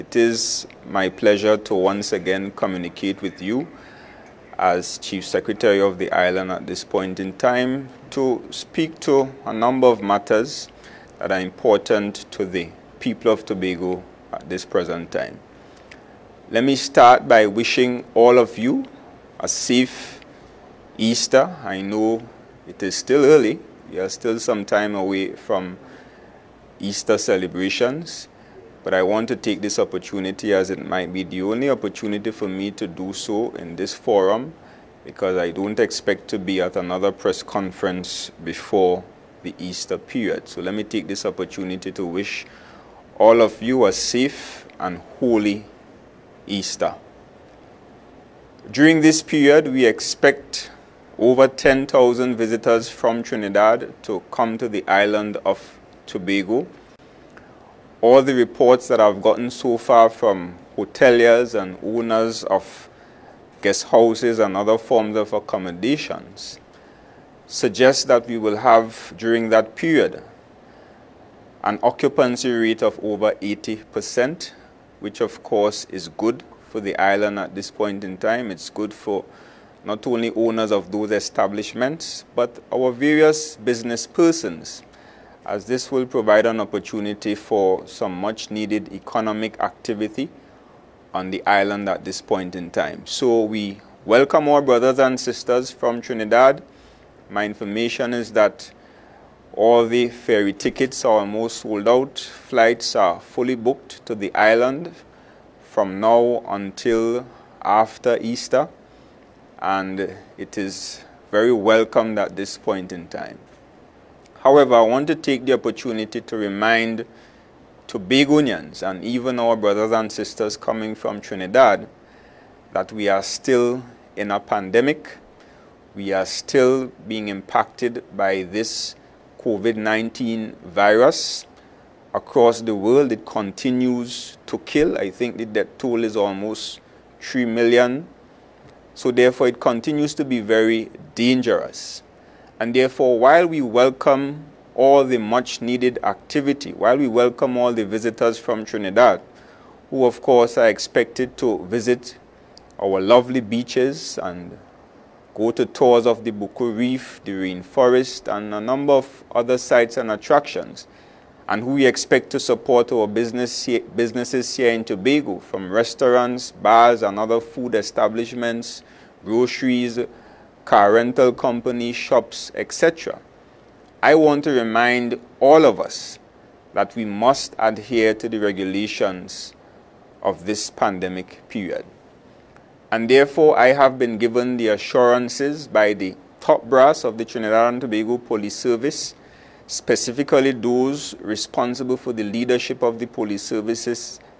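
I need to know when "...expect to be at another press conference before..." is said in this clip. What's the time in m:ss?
0:35.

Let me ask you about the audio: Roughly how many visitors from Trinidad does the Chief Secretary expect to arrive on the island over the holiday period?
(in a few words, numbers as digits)
over 10,000.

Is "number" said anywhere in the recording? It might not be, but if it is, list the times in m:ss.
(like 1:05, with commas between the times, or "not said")
0:09, 2:38.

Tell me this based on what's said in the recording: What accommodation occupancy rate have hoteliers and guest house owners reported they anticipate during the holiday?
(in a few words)
over 80%.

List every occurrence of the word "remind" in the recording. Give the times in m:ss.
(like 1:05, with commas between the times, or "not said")
1:56, 2:54.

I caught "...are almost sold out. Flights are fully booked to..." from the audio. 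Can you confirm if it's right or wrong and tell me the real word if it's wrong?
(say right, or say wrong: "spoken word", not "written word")
right.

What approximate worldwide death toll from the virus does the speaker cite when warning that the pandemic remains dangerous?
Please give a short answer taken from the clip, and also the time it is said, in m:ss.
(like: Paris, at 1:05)
almost 3 million, at 2:16.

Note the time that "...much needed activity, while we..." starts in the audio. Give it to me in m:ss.
2:25.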